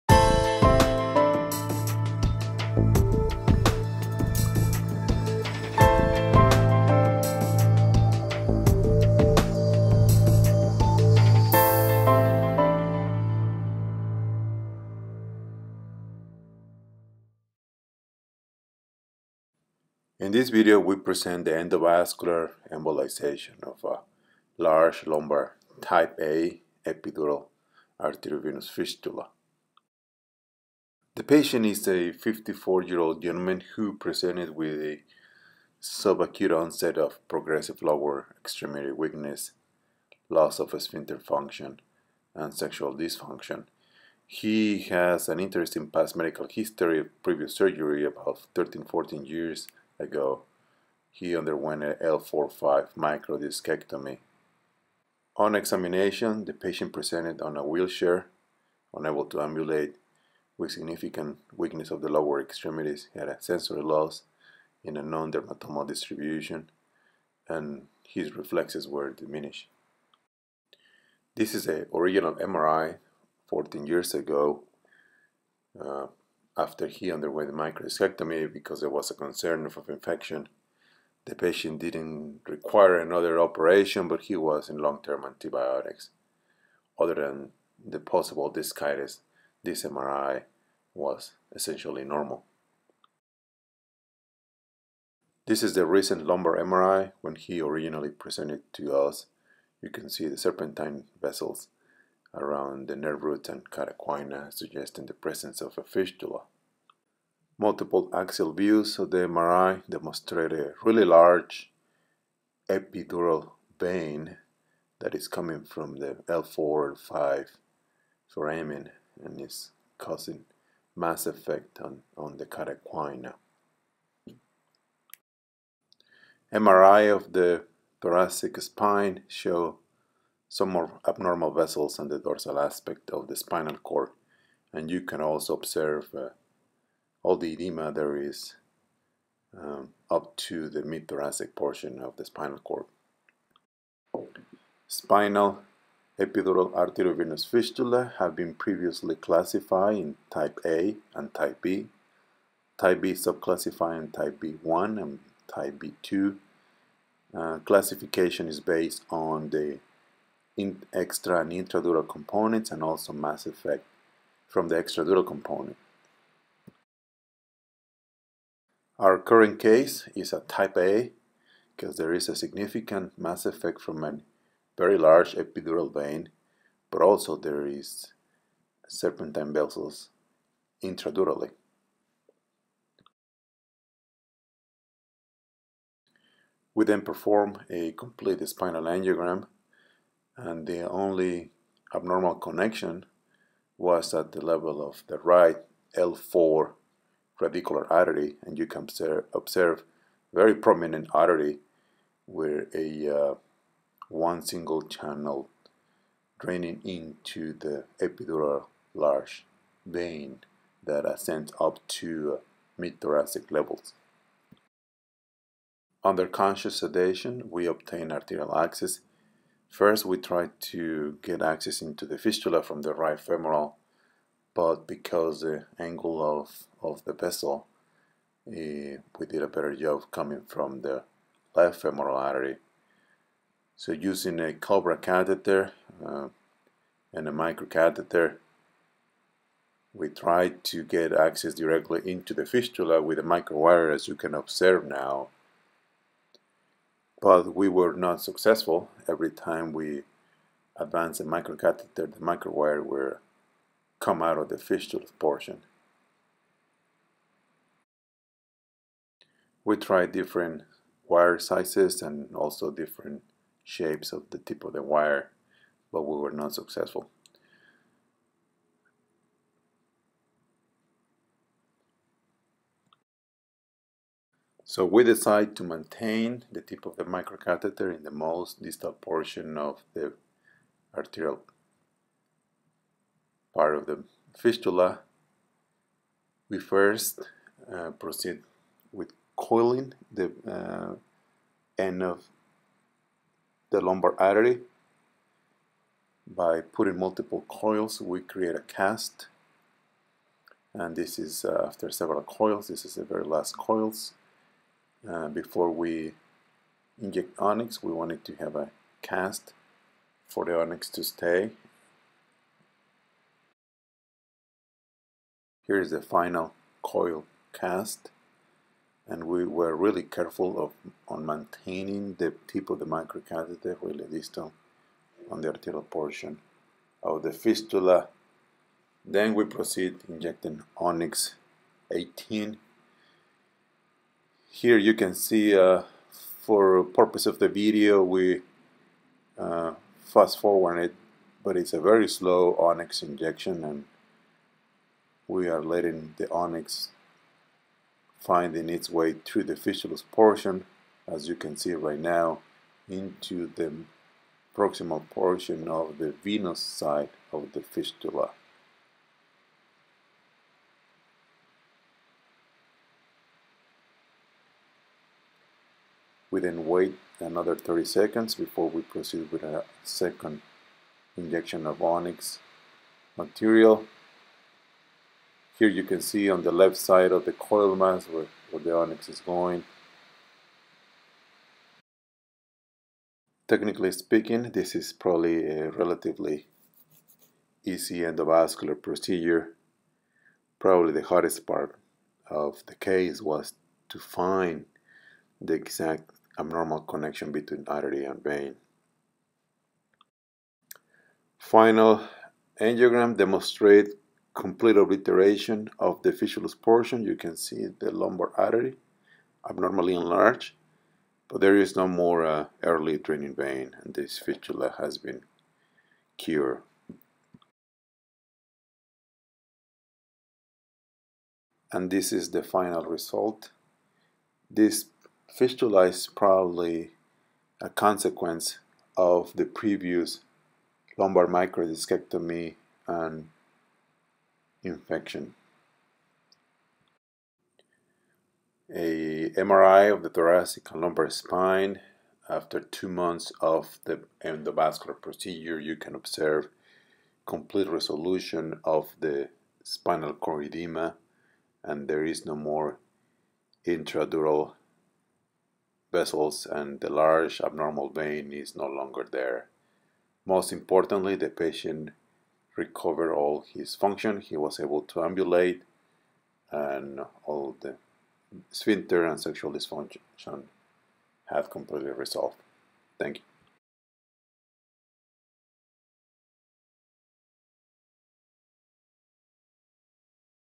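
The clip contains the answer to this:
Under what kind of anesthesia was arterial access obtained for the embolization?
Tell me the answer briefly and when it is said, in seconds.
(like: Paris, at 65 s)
Conscious sedation, at 216 s.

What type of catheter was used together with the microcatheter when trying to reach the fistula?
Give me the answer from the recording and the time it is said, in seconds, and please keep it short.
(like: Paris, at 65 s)
Cobra, at 234 s.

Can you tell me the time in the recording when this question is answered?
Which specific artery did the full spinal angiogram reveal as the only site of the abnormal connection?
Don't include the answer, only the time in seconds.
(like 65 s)
195 s.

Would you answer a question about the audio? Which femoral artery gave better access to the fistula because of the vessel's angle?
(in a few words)
Left femoral artery.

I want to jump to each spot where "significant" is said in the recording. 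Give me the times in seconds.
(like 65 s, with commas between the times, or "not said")
60 s, 172 s.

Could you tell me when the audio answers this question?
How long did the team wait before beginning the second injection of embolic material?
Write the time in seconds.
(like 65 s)
367 s.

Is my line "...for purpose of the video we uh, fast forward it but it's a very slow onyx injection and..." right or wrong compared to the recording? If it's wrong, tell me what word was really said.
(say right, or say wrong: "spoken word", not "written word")
right.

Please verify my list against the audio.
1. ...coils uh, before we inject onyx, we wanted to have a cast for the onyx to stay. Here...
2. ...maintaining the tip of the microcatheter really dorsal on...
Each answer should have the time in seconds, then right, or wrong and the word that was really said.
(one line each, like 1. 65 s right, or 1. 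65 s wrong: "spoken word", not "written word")
1. 303 s right
2. 321 s wrong: "distal", not "dorsal".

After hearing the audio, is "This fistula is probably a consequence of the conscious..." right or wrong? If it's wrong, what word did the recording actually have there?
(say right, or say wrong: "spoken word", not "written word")
wrong: "previous", not "conscious".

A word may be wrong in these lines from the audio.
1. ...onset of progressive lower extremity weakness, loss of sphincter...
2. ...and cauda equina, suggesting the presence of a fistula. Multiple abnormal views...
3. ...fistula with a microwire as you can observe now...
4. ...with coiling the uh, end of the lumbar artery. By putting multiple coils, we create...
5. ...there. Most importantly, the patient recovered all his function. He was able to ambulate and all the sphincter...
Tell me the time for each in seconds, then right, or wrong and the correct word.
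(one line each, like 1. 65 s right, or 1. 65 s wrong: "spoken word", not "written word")
1. 36 s right
2. 103 s wrong: "axial", not "abnormal"
3. 242 s right
4. 288 s right
5. 459 s right.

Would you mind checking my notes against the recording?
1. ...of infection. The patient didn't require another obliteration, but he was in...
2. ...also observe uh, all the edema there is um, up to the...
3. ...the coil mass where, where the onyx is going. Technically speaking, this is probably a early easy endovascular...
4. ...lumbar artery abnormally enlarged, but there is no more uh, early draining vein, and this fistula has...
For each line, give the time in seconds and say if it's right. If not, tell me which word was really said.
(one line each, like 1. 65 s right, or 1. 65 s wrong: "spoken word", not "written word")
1. 79 s wrong: "operation", not "obliteration"
2. 135 s right
3. 377 s wrong: "relatively", not "early"
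4. 407 s right.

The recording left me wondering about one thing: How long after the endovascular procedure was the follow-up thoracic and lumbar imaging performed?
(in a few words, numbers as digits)
2 months.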